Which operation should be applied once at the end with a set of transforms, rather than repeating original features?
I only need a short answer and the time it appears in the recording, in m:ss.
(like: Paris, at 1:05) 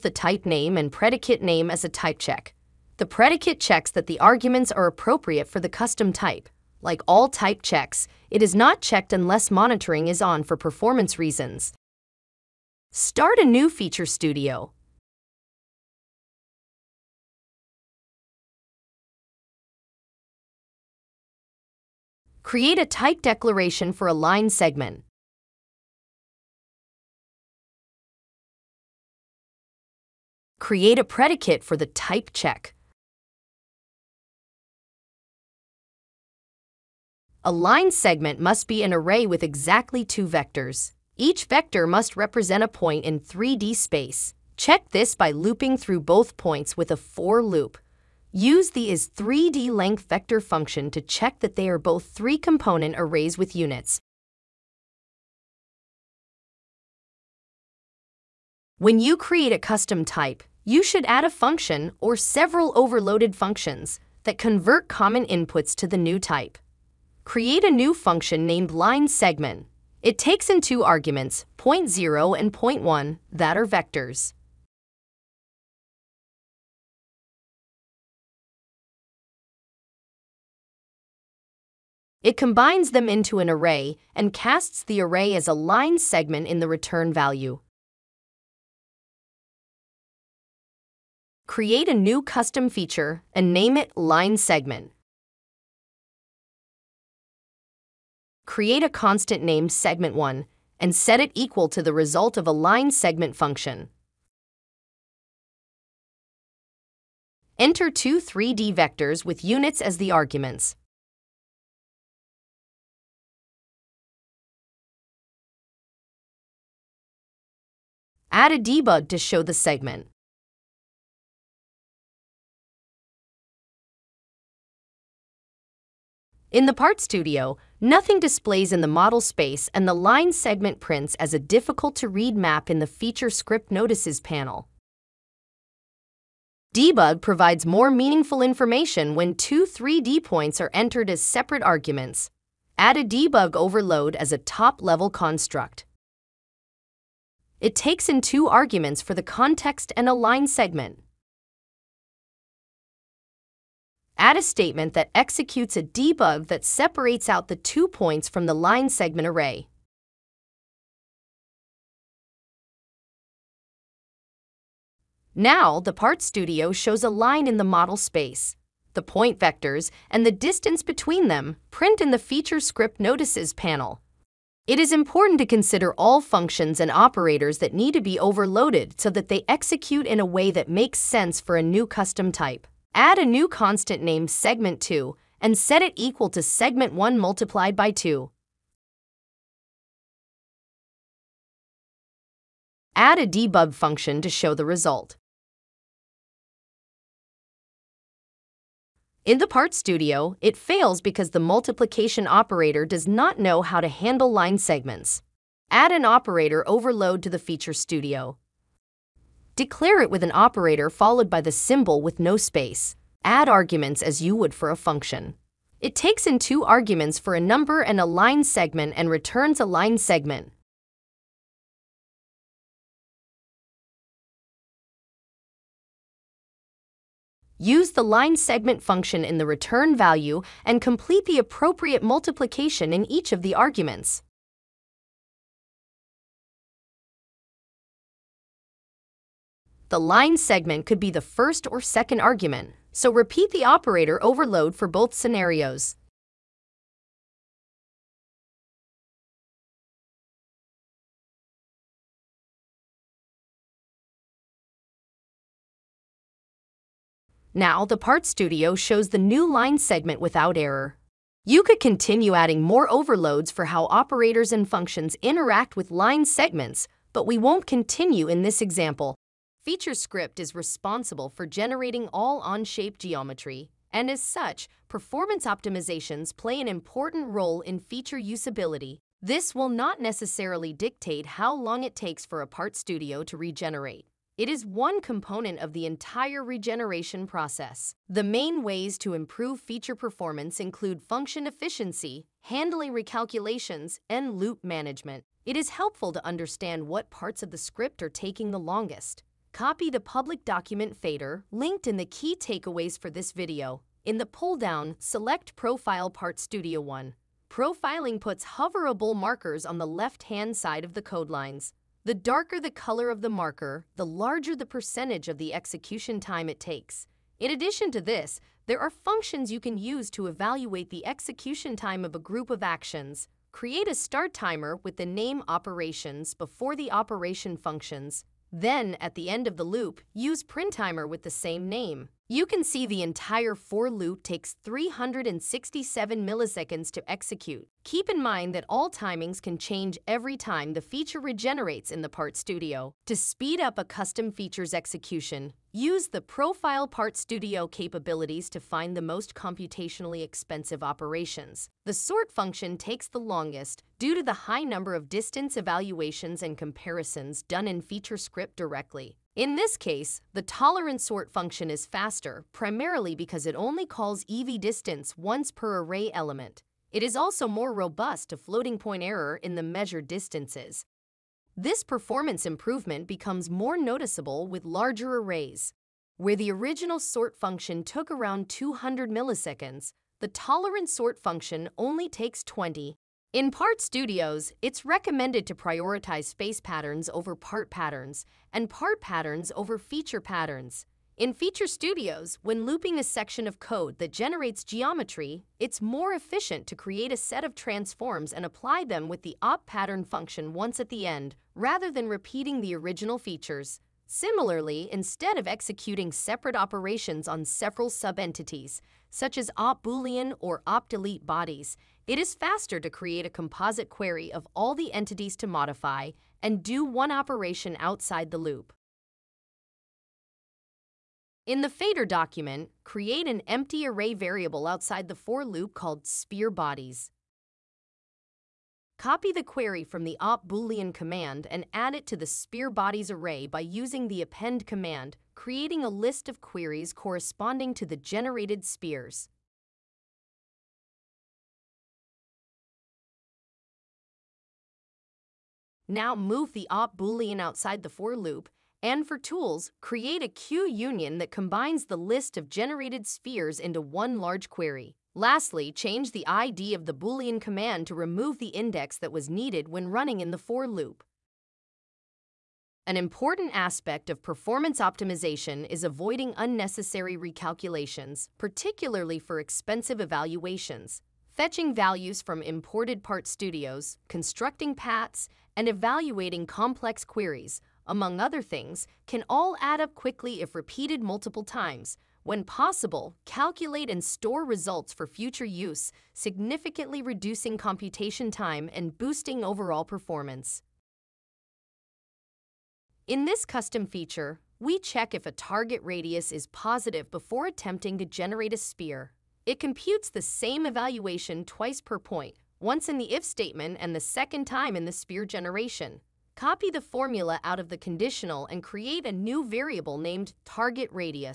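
op pattern, at 6:39.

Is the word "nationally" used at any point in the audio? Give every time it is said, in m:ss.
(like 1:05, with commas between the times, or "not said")
not said.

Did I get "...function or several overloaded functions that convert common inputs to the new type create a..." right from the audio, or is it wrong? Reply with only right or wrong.
right.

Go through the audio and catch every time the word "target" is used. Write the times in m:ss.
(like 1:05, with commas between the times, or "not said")
8:15, 8:30.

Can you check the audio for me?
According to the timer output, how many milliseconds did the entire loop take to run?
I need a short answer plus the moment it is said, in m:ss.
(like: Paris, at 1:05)
367, at 5:34.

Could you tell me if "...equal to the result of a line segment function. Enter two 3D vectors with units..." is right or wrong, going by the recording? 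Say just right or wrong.
right.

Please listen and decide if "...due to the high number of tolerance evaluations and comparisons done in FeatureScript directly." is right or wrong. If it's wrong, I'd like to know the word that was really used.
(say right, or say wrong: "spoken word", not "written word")
wrong: "distance", not "tolerance".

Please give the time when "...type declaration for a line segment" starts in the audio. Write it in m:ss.
0:22.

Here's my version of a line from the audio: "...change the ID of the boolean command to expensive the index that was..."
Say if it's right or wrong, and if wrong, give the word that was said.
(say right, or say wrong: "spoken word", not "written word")
wrong: "remove", not "expensive".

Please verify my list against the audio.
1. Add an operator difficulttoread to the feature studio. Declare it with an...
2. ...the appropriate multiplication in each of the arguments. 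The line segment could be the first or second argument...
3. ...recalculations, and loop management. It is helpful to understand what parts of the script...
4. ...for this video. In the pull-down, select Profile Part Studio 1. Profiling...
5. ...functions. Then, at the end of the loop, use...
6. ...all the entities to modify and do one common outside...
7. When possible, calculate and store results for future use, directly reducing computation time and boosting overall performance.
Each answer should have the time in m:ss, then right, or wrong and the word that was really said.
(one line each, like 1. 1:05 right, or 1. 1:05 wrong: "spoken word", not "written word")
1. 3:25 wrong: "overload", not "difficulttoread"
2. 3:51 right
3. 4:52 right
4. 5:02 right
5. 5:27 right
6. 6:54 wrong: "operation", not "common"
7. 8:02 wrong: "significantly", not "directly".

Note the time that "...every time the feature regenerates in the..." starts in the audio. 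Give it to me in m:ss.
5:40.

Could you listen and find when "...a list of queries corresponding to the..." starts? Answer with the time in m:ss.
7:15.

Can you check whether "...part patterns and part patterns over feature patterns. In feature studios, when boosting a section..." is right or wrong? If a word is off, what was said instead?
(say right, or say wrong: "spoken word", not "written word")
wrong: "looping", not "boosting".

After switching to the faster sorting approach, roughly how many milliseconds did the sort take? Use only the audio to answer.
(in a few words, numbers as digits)
20.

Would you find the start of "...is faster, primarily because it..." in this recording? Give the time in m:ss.
6:01.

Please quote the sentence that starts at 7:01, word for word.
In the fader document, create an empty array variable outside the for loop called sphere bodies.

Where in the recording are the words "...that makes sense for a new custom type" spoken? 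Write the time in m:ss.
3:00.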